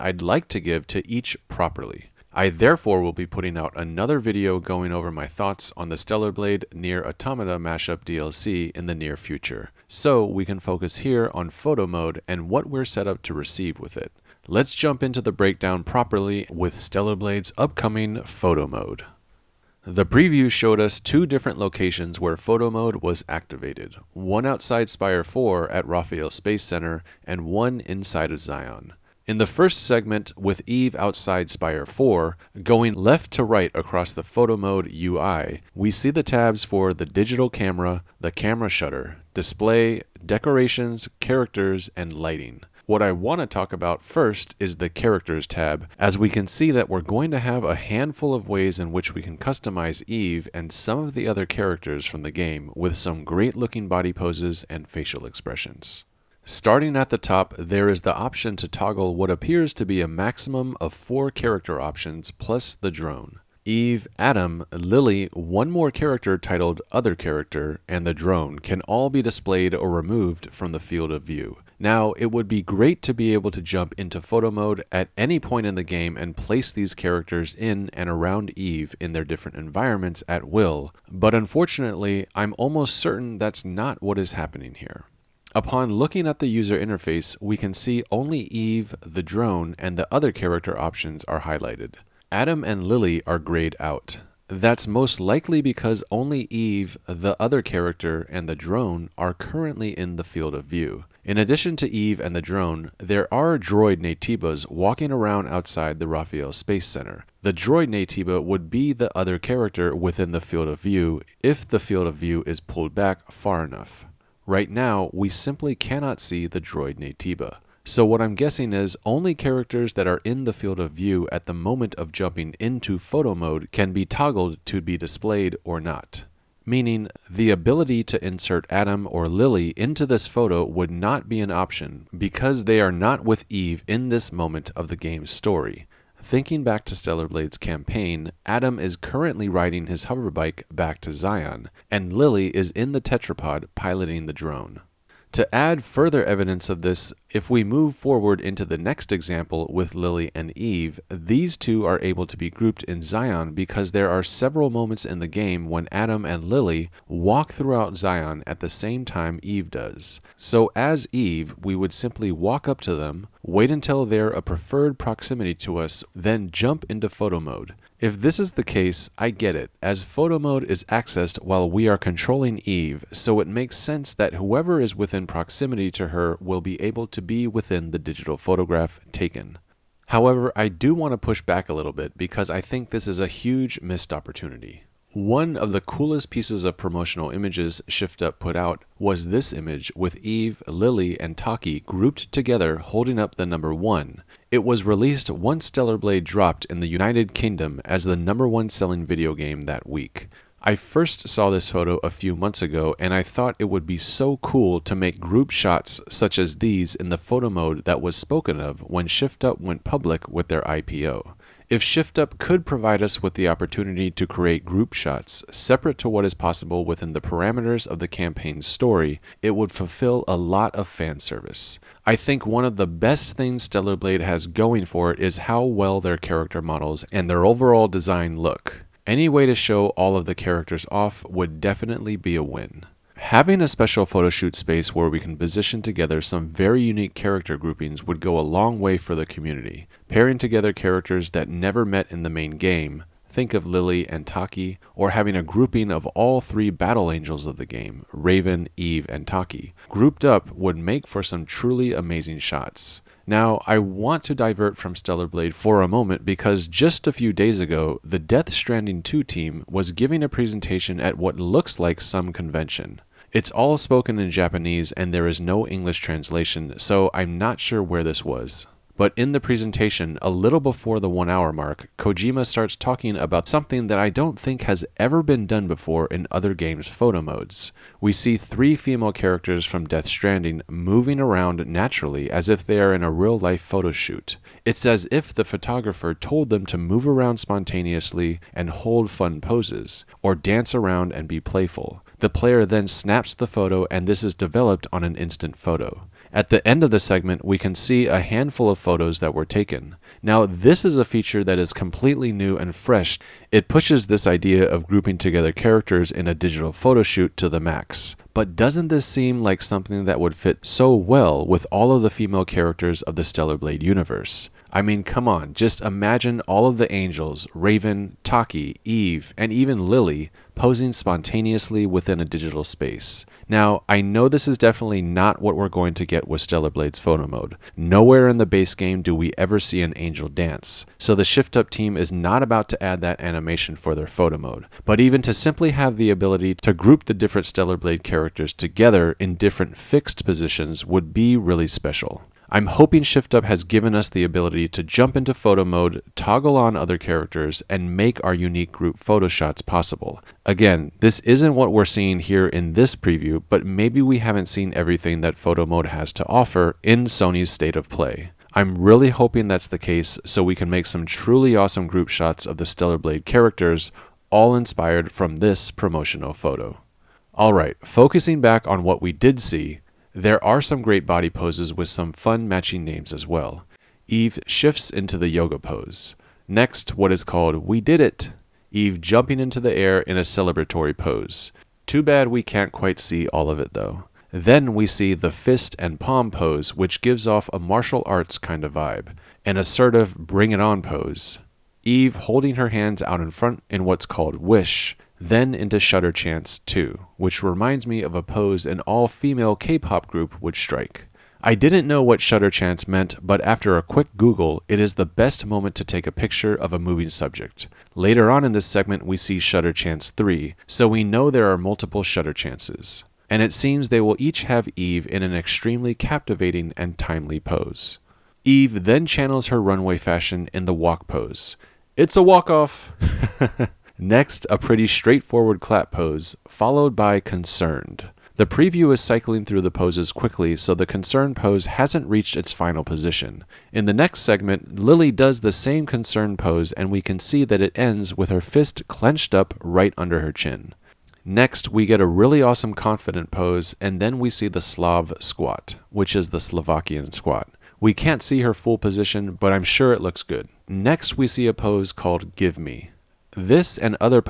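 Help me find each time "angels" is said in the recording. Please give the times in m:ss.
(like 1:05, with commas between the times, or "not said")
4:07, 5:16, 5:29.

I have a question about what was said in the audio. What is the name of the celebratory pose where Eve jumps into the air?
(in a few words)
We Did It.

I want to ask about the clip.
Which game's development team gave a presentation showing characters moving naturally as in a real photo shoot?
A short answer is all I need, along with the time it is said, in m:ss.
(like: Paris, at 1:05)
Death Stranding 2, at 4:18.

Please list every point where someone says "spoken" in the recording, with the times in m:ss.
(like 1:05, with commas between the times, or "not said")
3:28, 4:23.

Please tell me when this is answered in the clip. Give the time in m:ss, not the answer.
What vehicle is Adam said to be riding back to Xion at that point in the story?
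2:20.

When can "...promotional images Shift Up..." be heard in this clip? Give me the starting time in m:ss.
3:06.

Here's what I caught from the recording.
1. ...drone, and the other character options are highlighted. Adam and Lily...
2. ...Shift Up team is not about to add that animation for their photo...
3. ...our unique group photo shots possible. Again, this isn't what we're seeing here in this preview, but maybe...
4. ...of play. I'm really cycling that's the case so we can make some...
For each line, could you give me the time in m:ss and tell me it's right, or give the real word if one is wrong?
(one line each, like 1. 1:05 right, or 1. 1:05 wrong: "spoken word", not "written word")
1. 1:29 right
2. 5:31 right
3. 5:48 right
4. 5:57 wrong: "hoping", not "cycling".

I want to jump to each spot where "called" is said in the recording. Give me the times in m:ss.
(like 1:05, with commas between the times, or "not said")
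6:17, 6:34, 7:31.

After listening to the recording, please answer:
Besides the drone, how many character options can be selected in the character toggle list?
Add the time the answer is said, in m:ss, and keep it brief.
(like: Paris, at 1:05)
4, at 1:00.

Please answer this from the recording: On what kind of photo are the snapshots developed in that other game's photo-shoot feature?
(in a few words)
instant photo.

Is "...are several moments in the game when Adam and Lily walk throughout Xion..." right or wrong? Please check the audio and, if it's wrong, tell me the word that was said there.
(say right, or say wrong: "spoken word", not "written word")
right.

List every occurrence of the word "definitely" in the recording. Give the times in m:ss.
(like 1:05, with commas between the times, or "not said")
3:51, 5:24.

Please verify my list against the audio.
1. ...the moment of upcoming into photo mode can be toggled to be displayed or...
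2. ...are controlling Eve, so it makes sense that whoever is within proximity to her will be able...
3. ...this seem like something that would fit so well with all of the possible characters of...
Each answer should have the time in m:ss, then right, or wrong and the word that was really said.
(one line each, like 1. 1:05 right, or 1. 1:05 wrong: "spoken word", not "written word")
1. 2:01 wrong: "jumping", not "upcoming"
2. 2:51 right
3. 5:08 wrong: "female", not "possible".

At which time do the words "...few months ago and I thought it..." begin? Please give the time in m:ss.
3:22.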